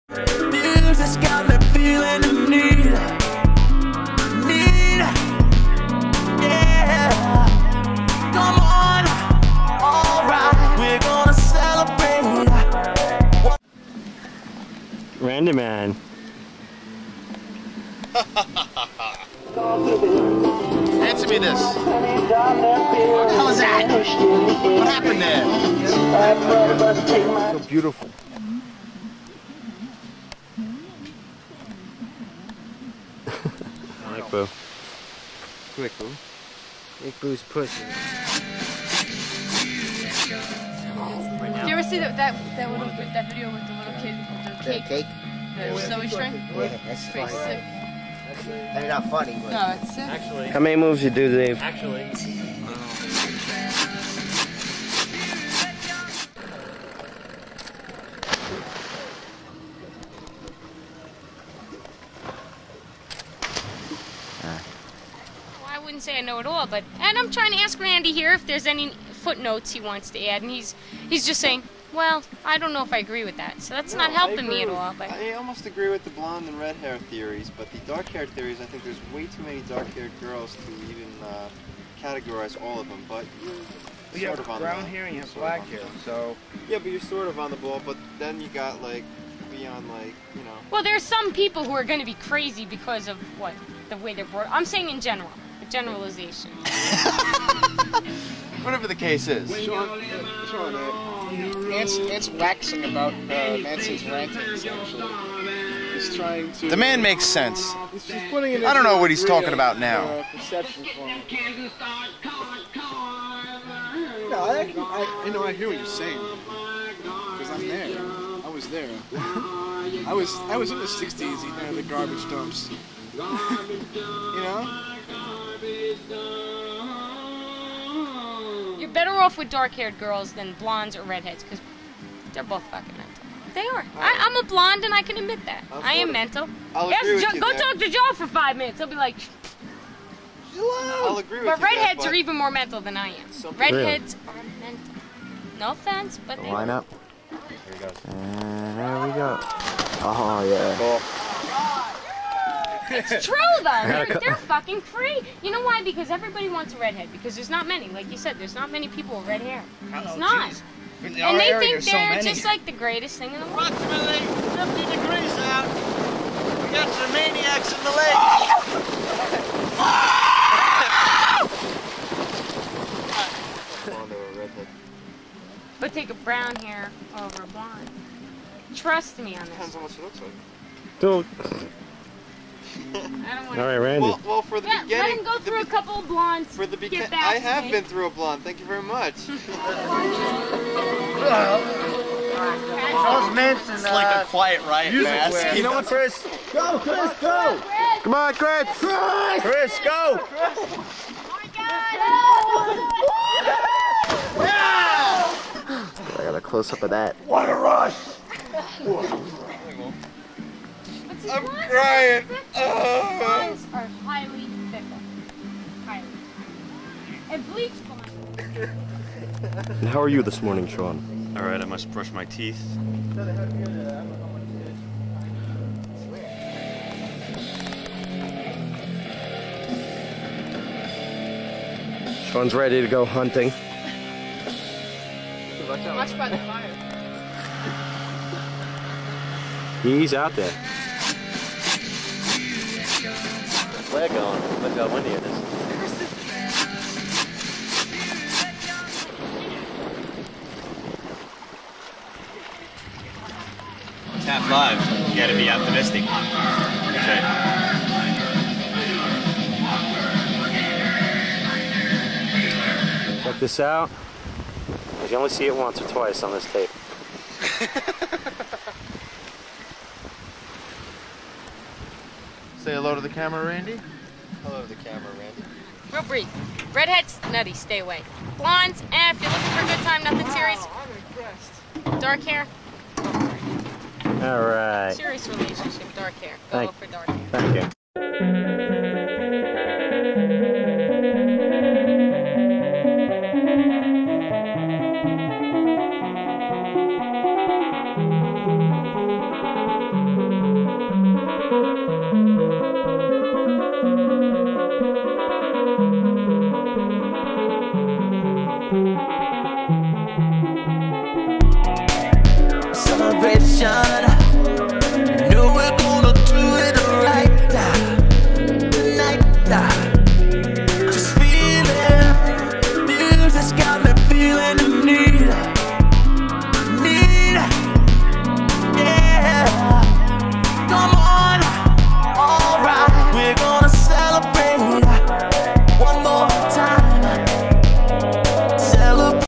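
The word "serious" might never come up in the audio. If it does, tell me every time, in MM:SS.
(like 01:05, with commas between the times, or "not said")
04:40, 04:44.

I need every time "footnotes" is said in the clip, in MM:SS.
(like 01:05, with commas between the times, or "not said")
01:09.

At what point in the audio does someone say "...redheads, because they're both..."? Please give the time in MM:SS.
02:11.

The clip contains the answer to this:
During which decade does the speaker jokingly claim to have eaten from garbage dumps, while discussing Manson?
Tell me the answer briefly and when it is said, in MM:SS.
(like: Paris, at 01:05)
the 60s, at 02:00.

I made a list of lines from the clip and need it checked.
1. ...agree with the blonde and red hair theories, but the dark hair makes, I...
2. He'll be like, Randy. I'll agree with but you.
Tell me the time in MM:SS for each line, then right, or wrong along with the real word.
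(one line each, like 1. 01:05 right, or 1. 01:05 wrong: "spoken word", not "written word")
1. 01:15 wrong: "theories", not "makes"
2. 02:18 wrong: "Hello", not "Randy".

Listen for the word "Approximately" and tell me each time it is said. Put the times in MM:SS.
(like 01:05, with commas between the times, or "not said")
02:43.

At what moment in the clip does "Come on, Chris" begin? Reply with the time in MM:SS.
03:18.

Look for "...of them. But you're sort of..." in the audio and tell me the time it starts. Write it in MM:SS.
01:22.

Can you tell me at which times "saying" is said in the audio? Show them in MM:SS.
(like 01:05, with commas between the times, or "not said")
01:11, 01:34, 01:55.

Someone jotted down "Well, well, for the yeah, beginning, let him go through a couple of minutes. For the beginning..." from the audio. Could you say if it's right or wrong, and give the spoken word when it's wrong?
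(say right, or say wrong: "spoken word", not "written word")
wrong: "blondes", not "minutes".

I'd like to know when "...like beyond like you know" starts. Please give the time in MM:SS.
01:28.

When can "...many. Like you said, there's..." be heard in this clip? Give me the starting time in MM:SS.
02:37.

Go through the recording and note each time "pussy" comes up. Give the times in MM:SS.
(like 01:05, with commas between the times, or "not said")
00:37.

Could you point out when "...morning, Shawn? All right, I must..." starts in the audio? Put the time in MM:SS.
03:40.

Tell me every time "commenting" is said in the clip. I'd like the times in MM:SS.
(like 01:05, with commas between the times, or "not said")
not said.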